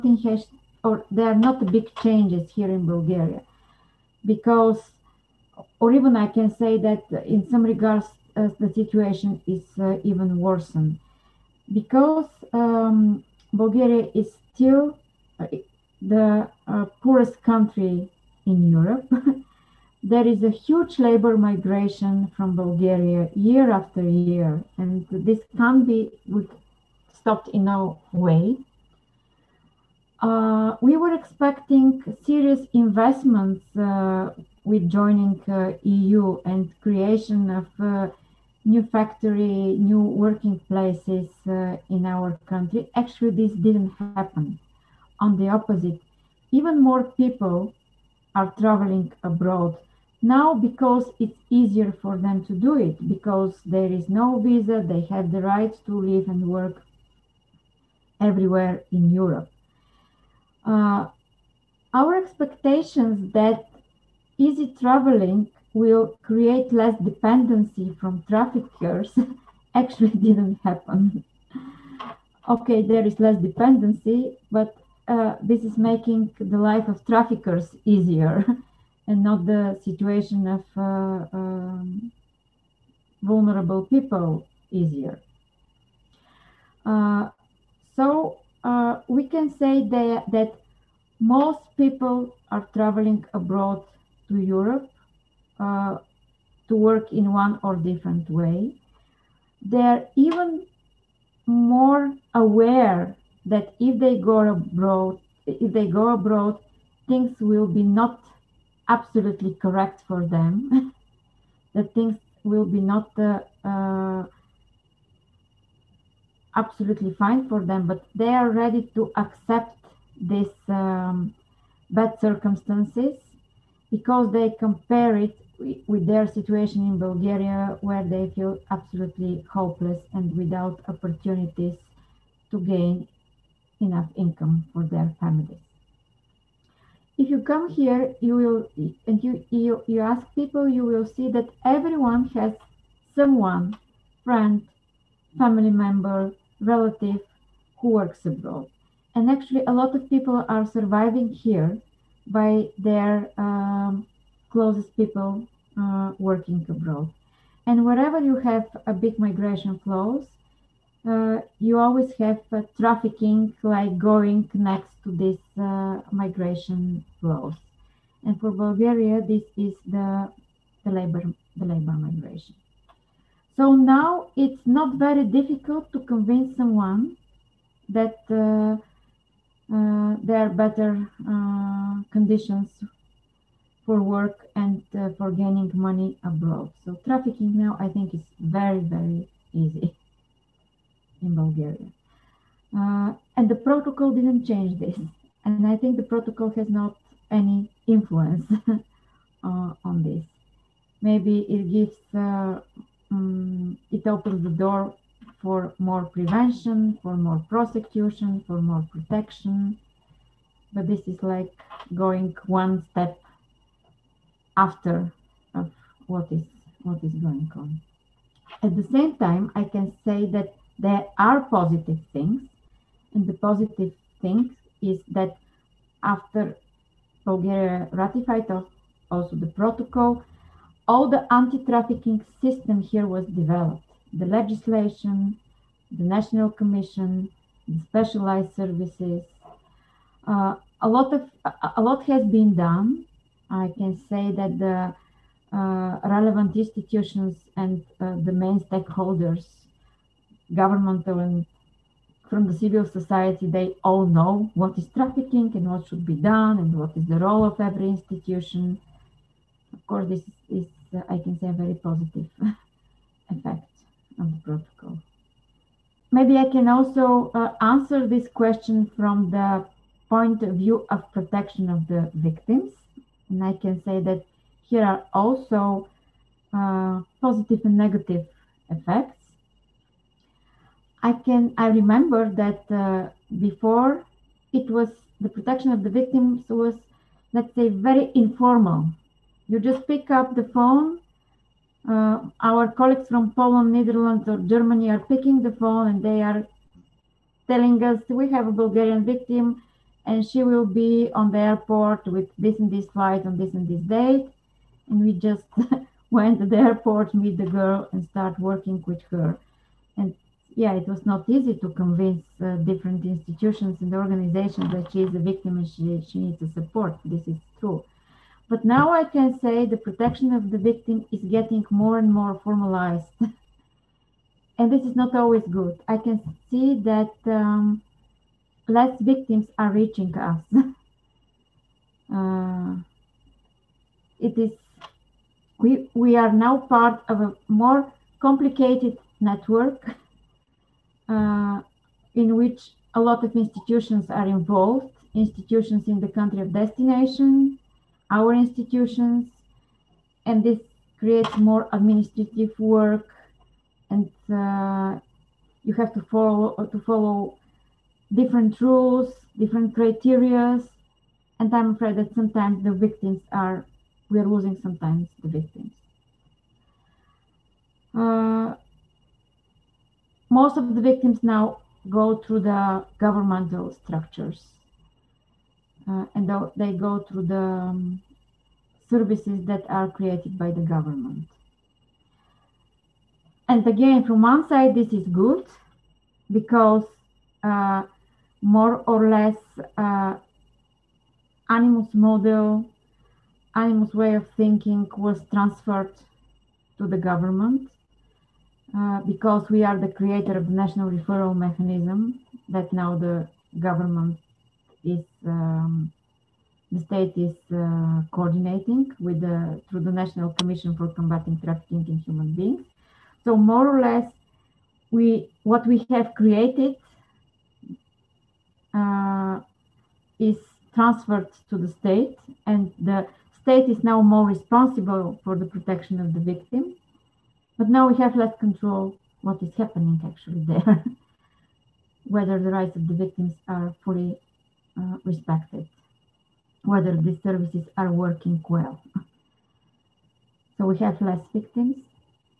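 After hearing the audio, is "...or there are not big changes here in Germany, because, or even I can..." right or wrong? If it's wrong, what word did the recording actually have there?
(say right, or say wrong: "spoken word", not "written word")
wrong: "Bulgaria", not "Germany".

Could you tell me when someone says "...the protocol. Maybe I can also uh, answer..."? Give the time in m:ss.
4:24.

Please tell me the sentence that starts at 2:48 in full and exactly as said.
And for Bulgaria, this is the, the labor the labor migration.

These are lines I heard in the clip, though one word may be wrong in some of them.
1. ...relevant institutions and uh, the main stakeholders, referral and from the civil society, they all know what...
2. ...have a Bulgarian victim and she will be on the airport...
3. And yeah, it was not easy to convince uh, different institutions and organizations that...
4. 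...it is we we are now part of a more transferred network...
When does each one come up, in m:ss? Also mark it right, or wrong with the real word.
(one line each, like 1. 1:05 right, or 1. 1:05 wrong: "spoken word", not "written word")
1. 4:06 wrong: "governmental", not "referral"
2. 4:58 right
3. 5:09 right
4. 5:34 wrong: "complicated", not "transferred".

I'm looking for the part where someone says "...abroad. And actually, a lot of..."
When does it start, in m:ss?
2:28.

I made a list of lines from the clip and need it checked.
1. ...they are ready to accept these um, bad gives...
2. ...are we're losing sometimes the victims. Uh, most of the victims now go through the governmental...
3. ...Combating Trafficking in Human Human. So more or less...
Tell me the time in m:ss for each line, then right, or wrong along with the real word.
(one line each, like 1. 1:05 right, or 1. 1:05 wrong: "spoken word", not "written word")
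1. 1:58 wrong: "circumstances", not "gives"
2. 6:03 right
3. 6:50 wrong: "Beings", not "Human".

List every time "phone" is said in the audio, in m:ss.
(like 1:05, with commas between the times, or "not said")
4:50, 4:55.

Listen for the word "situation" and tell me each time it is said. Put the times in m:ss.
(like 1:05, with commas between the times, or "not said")
0:08, 1:19, 2:06.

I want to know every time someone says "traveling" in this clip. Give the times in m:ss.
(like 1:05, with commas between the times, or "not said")
0:48, 1:04, 1:32.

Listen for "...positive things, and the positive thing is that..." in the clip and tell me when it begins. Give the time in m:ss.
3:41.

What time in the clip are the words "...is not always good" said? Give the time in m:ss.
5:24.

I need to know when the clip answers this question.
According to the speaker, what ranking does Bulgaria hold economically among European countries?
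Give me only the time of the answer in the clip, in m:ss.
0:17.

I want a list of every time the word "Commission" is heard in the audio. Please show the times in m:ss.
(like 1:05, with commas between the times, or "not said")
3:56, 6:50.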